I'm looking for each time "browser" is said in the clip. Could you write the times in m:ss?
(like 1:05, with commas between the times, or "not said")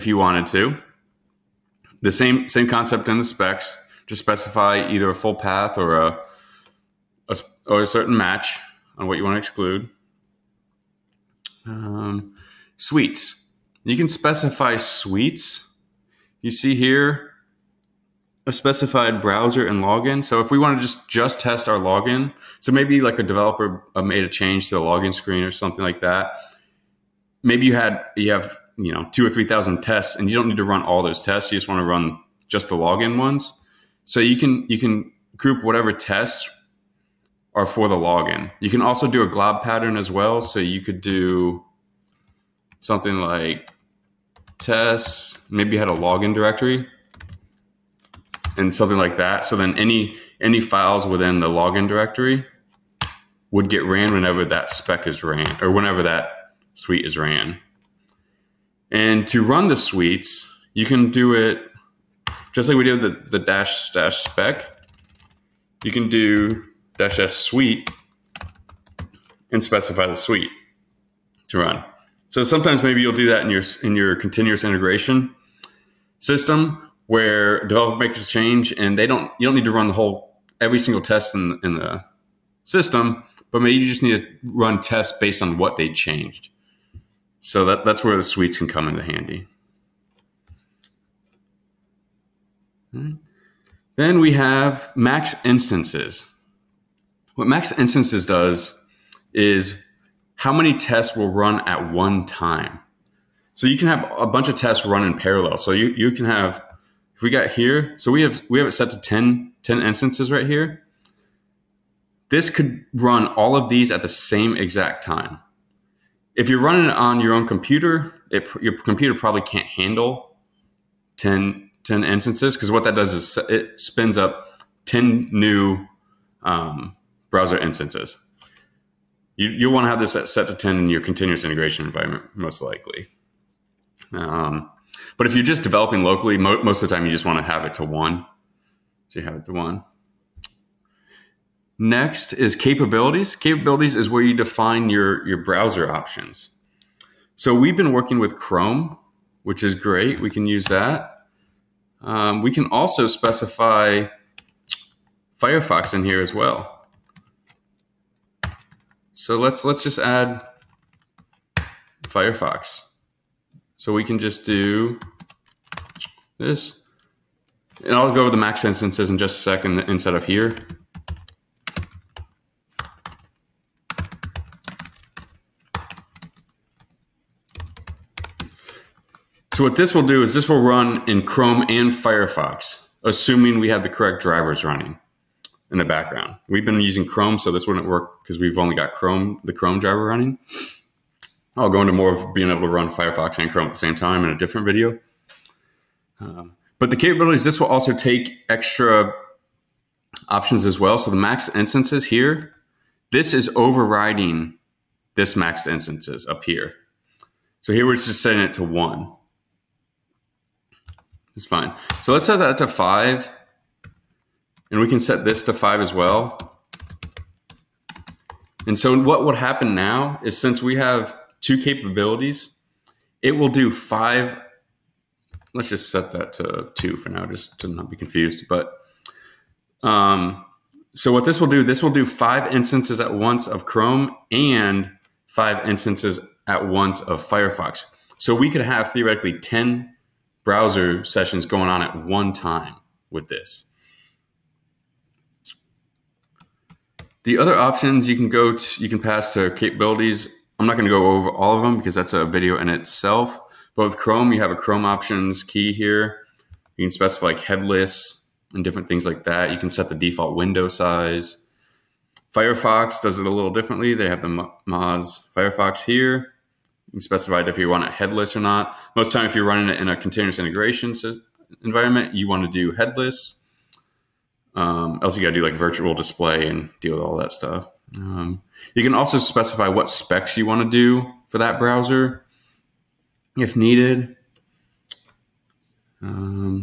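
0:19, 2:07, 2:25, 4:00, 4:41.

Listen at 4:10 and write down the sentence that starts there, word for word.
I'm not going to go over all of them because that's a video in itself.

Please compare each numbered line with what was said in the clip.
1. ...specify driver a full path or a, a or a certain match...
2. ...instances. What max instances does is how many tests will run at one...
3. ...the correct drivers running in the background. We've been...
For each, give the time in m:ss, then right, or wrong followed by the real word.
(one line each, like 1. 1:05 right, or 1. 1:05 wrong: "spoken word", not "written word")
1. 0:04 wrong: "either", not "driver"
2. 1:35 right
3. 3:03 right.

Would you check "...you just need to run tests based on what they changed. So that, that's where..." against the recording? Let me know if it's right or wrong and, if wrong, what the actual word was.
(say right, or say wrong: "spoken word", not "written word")
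right.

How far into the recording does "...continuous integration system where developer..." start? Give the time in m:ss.
1:14.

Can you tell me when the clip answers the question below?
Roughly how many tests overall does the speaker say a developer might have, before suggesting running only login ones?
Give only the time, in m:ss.
0:29.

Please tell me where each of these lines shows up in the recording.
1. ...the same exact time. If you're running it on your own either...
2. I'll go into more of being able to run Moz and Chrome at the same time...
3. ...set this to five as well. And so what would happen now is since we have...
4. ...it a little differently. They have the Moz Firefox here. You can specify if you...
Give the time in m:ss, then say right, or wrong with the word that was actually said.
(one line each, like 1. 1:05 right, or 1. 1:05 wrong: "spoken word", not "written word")
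1. 1:54 wrong: "computer", not "either"
2. 3:11 wrong: "Firefox", not "Moz"
3. 3:35 right
4. 4:23 right.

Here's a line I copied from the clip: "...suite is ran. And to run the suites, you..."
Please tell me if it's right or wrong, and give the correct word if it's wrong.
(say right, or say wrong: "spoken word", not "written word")
right.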